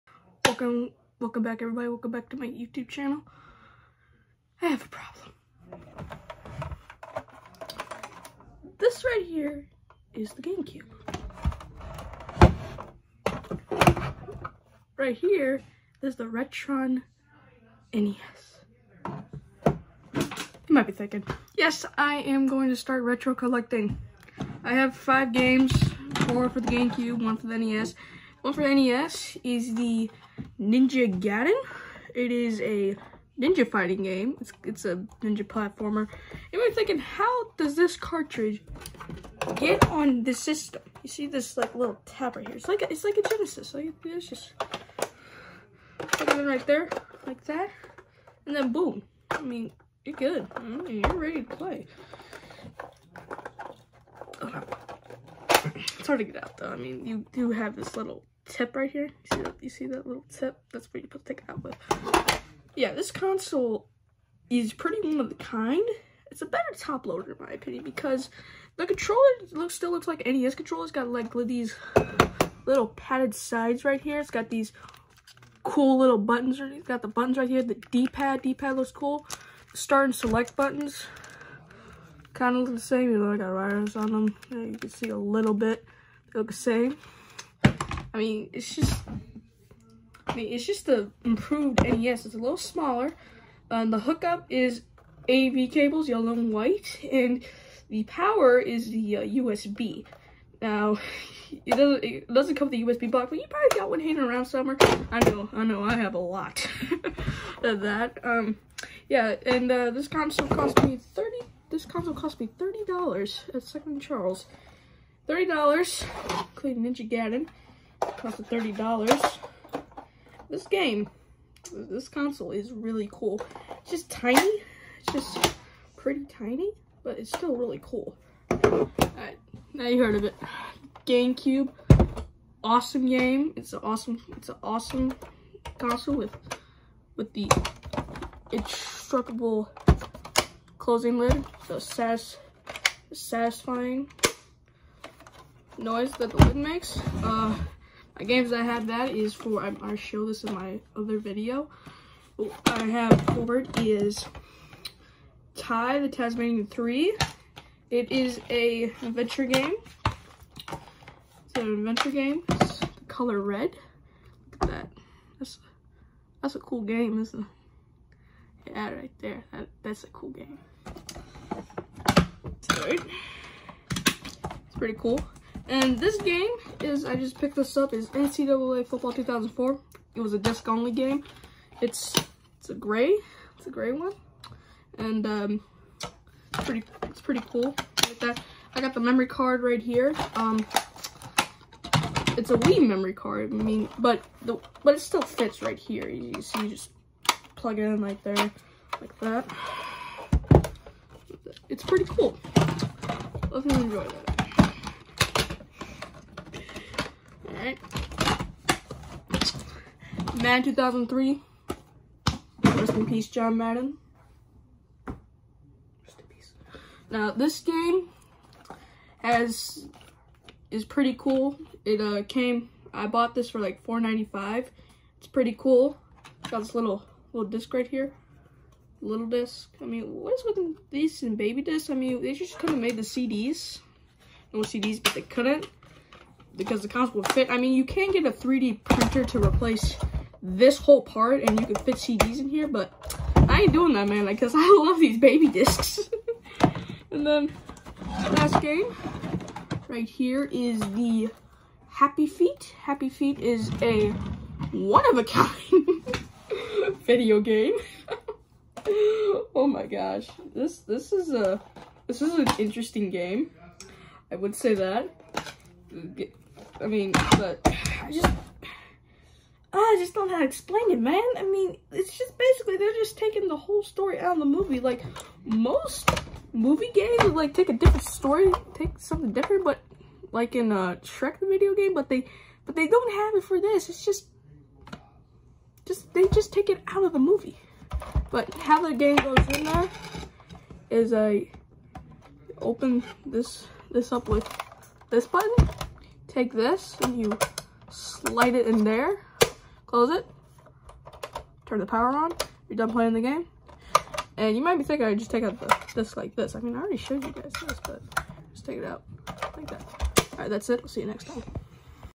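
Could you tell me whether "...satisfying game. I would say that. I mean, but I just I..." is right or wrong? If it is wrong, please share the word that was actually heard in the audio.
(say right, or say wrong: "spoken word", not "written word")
wrong: "interesting", not "satisfying".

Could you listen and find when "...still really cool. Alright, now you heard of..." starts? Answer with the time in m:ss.
2:07.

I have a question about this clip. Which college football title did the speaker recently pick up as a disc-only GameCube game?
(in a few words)
NCAA Football 2004.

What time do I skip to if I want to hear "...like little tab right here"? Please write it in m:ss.
0:41.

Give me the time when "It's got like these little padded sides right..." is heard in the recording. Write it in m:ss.
1:10.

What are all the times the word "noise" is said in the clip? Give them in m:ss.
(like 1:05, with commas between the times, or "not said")
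2:25.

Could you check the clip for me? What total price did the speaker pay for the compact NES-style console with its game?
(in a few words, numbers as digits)
$30.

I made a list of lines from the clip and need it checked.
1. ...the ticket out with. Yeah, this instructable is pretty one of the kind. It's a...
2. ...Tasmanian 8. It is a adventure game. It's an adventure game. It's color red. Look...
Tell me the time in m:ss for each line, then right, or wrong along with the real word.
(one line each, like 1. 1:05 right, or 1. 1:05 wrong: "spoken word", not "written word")
1. 1:01 wrong: "console", not "instructable"
2. 2:36 wrong: "3", not "8".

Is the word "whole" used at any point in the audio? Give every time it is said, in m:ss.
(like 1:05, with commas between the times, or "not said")
4:00, 4:33.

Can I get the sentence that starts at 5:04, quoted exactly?
And you might be thinking I just take out the, this like this.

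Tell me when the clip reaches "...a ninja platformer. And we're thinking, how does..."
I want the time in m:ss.
0:34.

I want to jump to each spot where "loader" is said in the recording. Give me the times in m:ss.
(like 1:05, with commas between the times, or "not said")
1:07.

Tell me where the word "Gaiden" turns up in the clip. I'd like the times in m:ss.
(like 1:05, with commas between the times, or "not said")
0:31, 1:57.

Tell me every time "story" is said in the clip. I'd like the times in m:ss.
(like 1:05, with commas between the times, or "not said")
4:33, 4:38.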